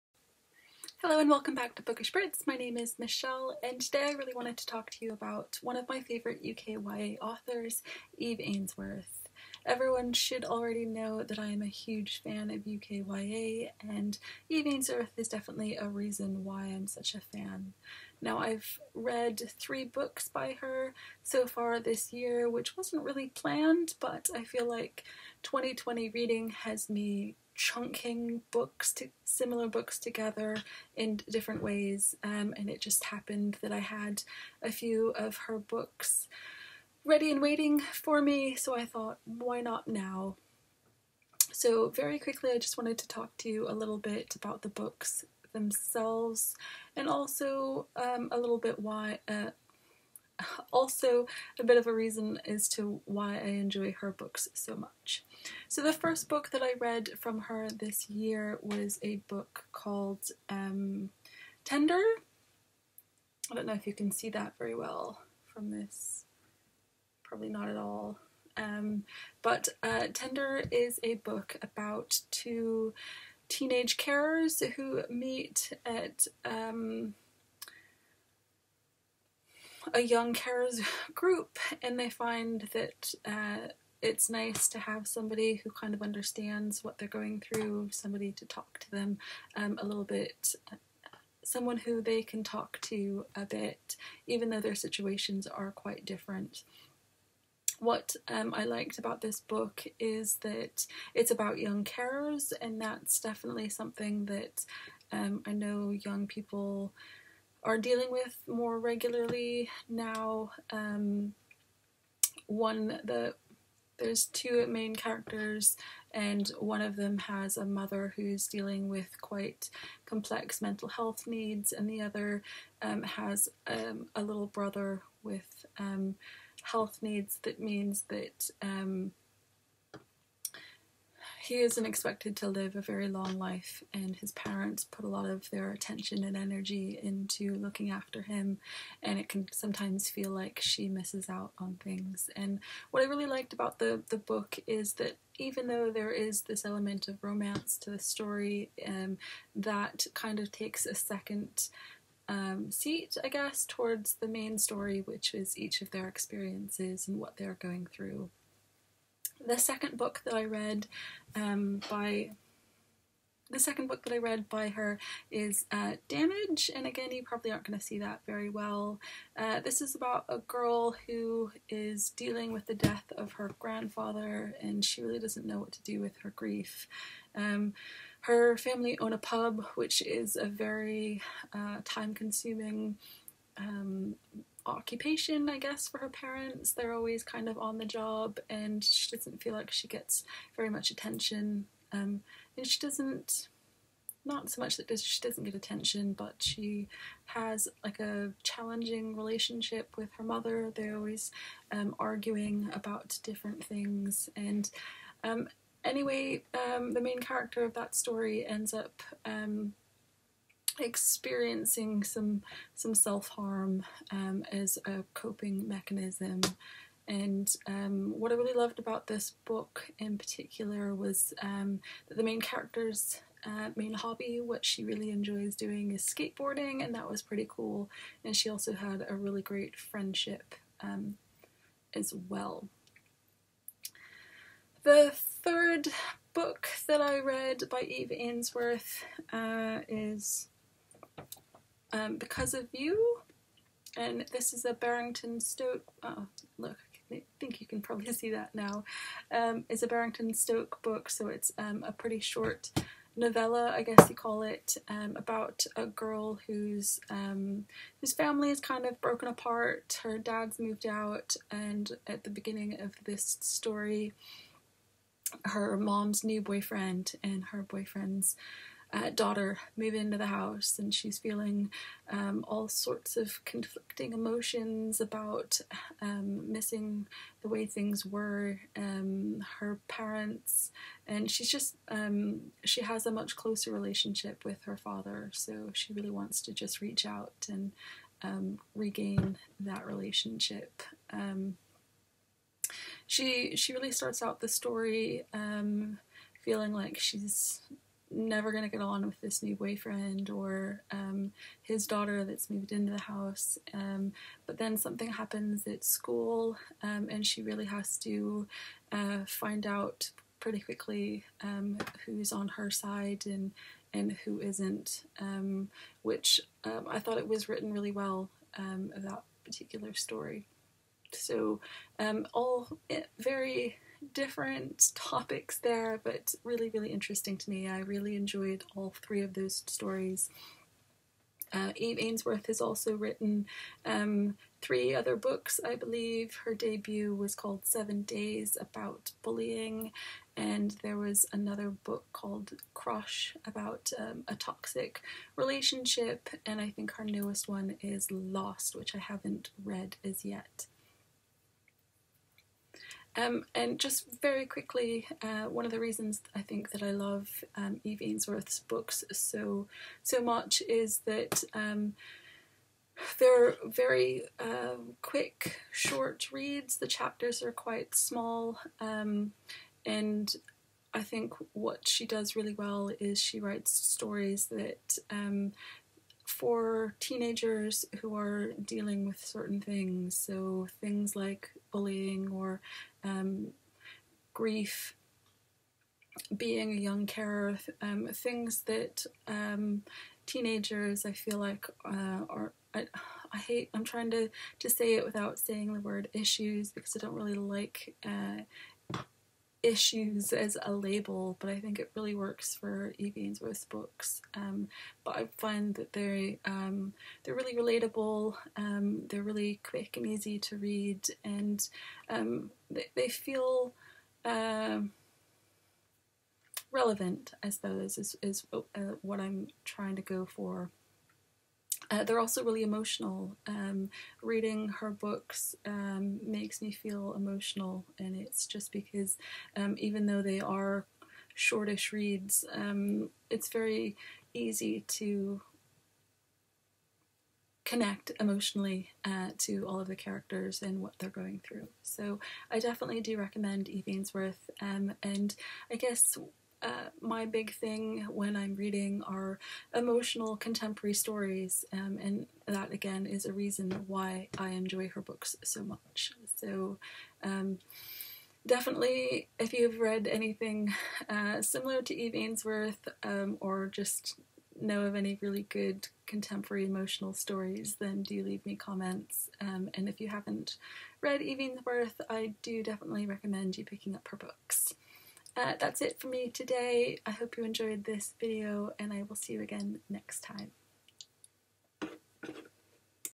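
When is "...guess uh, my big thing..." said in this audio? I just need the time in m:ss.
7:25.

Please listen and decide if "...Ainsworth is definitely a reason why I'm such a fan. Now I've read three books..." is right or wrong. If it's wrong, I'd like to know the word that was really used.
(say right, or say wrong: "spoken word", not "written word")
right.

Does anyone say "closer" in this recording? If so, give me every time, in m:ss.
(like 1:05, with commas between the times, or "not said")
4:43.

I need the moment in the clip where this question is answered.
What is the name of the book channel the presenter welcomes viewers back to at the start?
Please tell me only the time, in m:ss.
0:01.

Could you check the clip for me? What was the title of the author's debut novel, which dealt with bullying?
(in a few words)
Seven Days.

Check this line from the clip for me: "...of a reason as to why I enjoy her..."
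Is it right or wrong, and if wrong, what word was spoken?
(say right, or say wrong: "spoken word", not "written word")
right.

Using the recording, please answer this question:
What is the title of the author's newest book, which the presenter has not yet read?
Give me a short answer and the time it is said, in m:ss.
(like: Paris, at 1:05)
Lost, at 5:48.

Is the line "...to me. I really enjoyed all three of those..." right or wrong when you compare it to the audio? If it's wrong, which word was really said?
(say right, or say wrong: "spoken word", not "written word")
right.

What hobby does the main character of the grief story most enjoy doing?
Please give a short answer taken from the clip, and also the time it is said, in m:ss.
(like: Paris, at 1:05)
Skateboarding, at 3:46.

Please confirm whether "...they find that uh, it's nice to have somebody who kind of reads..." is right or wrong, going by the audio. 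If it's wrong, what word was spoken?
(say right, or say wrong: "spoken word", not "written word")
wrong: "understands", not "reads".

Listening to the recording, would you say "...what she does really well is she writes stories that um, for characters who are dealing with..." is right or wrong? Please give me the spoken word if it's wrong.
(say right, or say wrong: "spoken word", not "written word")
wrong: "teenagers", not "characters".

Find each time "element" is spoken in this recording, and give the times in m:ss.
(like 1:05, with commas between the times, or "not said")
2:26.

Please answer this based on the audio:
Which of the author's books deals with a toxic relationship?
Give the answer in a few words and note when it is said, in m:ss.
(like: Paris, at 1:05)
Crush, at 5:42.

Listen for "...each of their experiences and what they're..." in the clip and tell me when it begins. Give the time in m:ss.
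2:35.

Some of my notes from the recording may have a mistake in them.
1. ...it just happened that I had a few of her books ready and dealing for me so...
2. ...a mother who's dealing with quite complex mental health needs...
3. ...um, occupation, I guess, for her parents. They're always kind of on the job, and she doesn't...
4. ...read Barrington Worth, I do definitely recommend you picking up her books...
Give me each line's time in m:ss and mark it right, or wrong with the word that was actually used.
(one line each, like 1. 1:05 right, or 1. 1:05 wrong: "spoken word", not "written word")
1. 0:32 wrong: "waiting", not "dealing"
2. 1:57 right
3. 3:03 right
4. 7:51 wrong: "Eve", not "Barrington".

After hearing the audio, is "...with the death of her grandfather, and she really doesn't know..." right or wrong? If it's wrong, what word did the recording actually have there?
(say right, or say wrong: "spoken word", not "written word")
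right.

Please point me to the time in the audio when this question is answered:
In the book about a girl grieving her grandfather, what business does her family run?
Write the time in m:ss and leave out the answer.
2:59.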